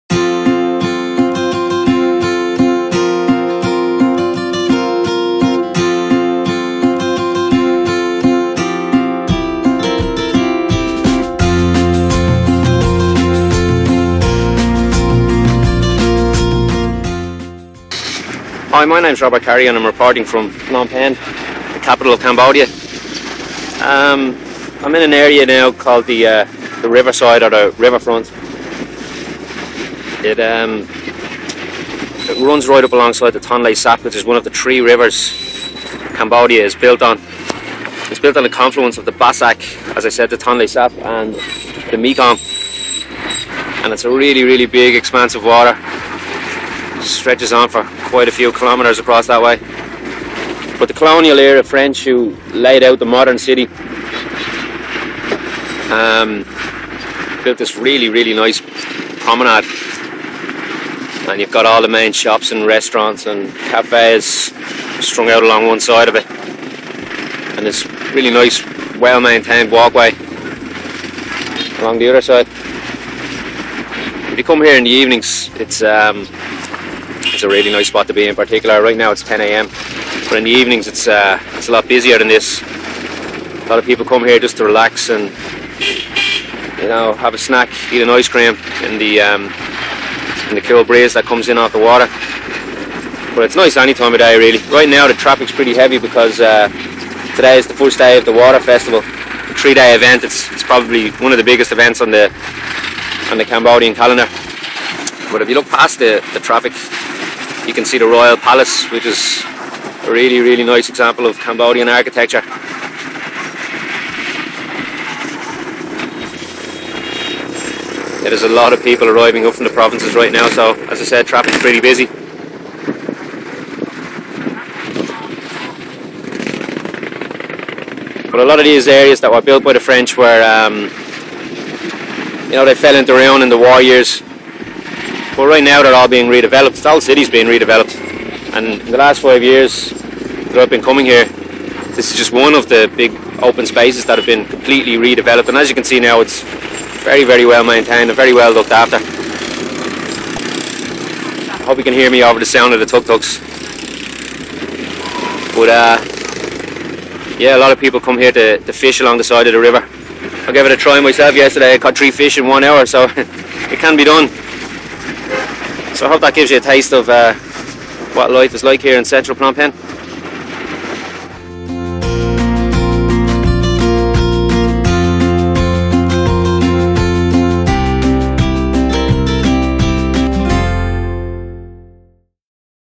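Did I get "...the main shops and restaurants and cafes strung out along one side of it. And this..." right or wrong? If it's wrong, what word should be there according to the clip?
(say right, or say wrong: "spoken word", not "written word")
right.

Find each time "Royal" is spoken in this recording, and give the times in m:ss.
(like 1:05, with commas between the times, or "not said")
1:48.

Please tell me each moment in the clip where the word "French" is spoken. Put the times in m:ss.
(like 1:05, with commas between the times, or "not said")
0:51, 2:09.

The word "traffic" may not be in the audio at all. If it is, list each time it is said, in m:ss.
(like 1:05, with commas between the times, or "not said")
1:35, 1:46, 2:01.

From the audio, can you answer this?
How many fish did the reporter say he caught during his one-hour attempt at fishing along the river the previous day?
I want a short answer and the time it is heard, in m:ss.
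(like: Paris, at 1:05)
3, at 2:41.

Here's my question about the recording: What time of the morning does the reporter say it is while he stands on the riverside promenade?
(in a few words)
10 a.m.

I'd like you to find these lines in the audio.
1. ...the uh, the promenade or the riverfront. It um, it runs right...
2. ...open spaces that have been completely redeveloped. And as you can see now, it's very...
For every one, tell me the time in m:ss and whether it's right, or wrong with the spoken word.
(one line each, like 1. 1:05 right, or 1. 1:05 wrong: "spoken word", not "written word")
1. 0:26 wrong: "riverside", not "promenade"
2. 2:23 right.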